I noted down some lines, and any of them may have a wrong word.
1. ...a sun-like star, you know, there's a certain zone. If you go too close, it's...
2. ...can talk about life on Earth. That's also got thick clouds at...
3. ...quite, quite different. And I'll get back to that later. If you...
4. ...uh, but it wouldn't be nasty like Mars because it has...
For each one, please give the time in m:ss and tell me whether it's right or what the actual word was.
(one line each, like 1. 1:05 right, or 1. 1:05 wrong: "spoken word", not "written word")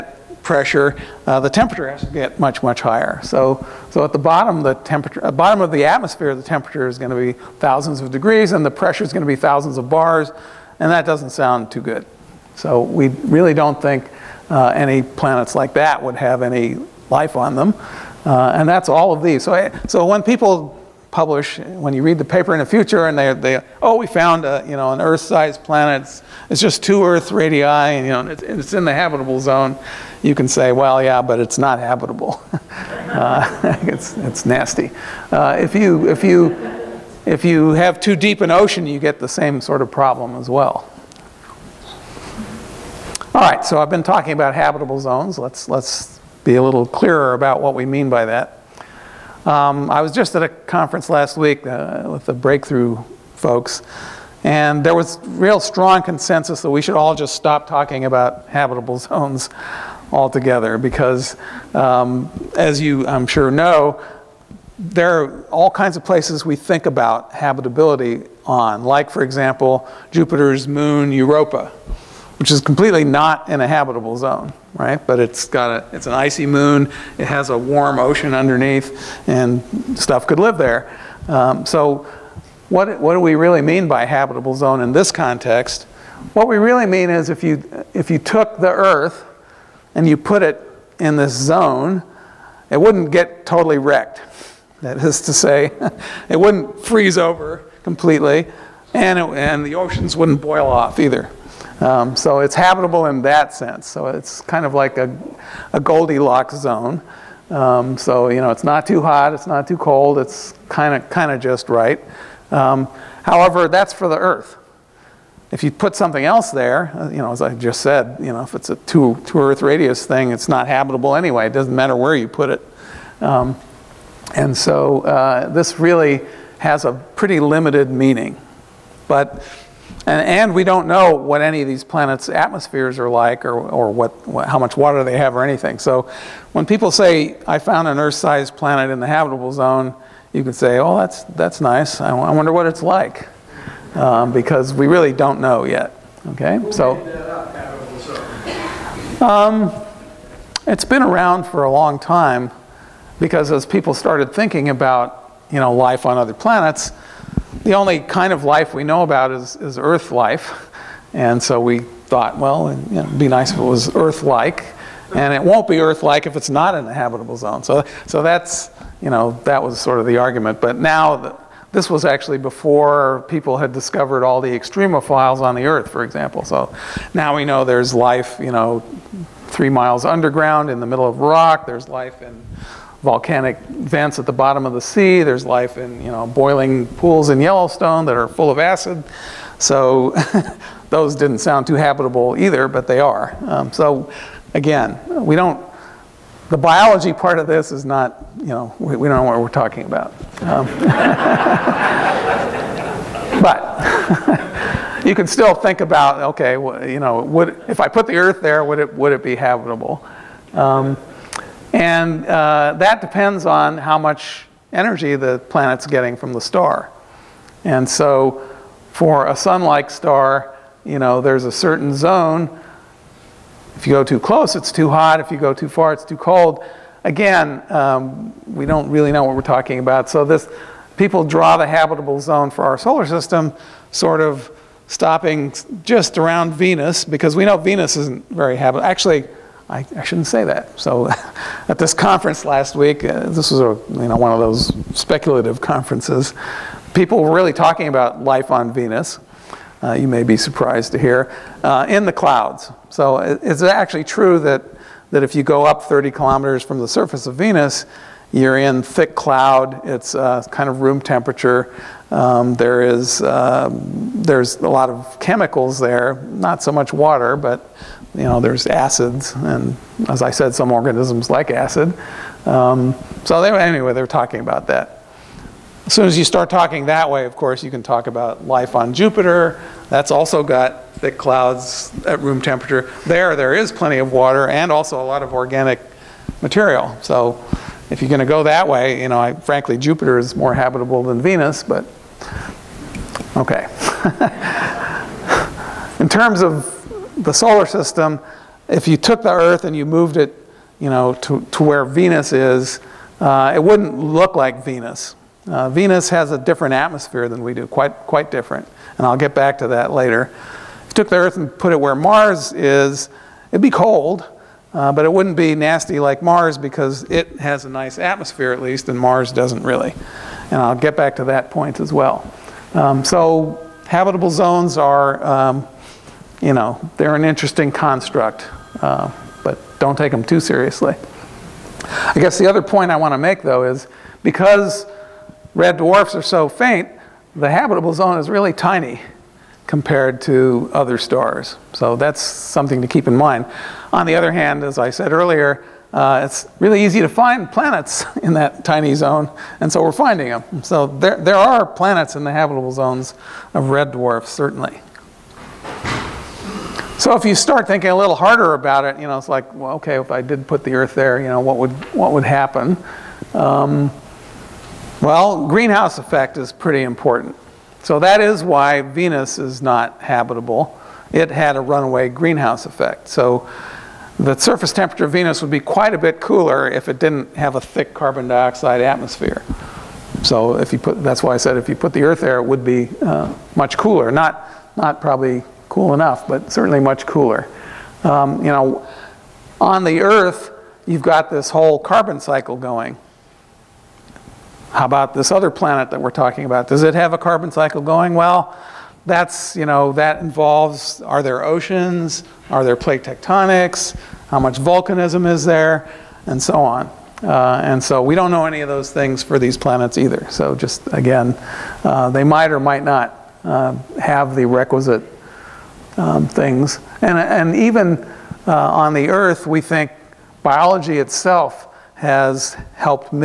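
1. 3:39 right
2. 4:37 wrong: "Jupiter", not "Earth"
3. 5:07 right
4. 5:14 right.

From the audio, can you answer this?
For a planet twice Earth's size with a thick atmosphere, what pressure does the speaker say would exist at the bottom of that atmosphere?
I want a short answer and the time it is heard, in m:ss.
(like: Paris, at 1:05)
thousands of bars, at 0:09.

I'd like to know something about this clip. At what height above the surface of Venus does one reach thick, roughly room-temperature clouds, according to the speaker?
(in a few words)
30 kilometers.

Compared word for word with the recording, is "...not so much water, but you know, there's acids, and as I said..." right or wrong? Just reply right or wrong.
right.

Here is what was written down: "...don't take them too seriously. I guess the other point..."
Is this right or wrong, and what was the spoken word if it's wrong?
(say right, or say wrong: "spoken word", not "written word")
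right.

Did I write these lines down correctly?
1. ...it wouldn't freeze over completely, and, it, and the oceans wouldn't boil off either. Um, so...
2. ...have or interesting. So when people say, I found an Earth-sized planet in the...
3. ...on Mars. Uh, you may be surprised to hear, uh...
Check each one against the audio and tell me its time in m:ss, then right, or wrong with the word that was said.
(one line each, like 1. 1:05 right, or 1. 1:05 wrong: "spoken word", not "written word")
1. 1:36 right
2. 2:15 wrong: "anything", not "interesting"
3. 4:08 wrong: "Venus", not "Mars".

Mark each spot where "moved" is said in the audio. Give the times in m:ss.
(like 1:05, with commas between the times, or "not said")
4:59.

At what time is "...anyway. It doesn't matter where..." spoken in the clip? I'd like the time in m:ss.
2:01.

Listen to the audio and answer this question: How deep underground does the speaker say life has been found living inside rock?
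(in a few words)
3 miles.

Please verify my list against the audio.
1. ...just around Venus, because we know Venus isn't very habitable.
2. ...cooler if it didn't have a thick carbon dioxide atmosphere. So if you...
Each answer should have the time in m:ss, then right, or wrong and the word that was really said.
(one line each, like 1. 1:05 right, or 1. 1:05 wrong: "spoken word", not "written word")
1. 3:55 right
2. 6:16 right.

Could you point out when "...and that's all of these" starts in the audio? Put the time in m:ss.
0:18.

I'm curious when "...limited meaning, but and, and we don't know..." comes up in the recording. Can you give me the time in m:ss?
2:07.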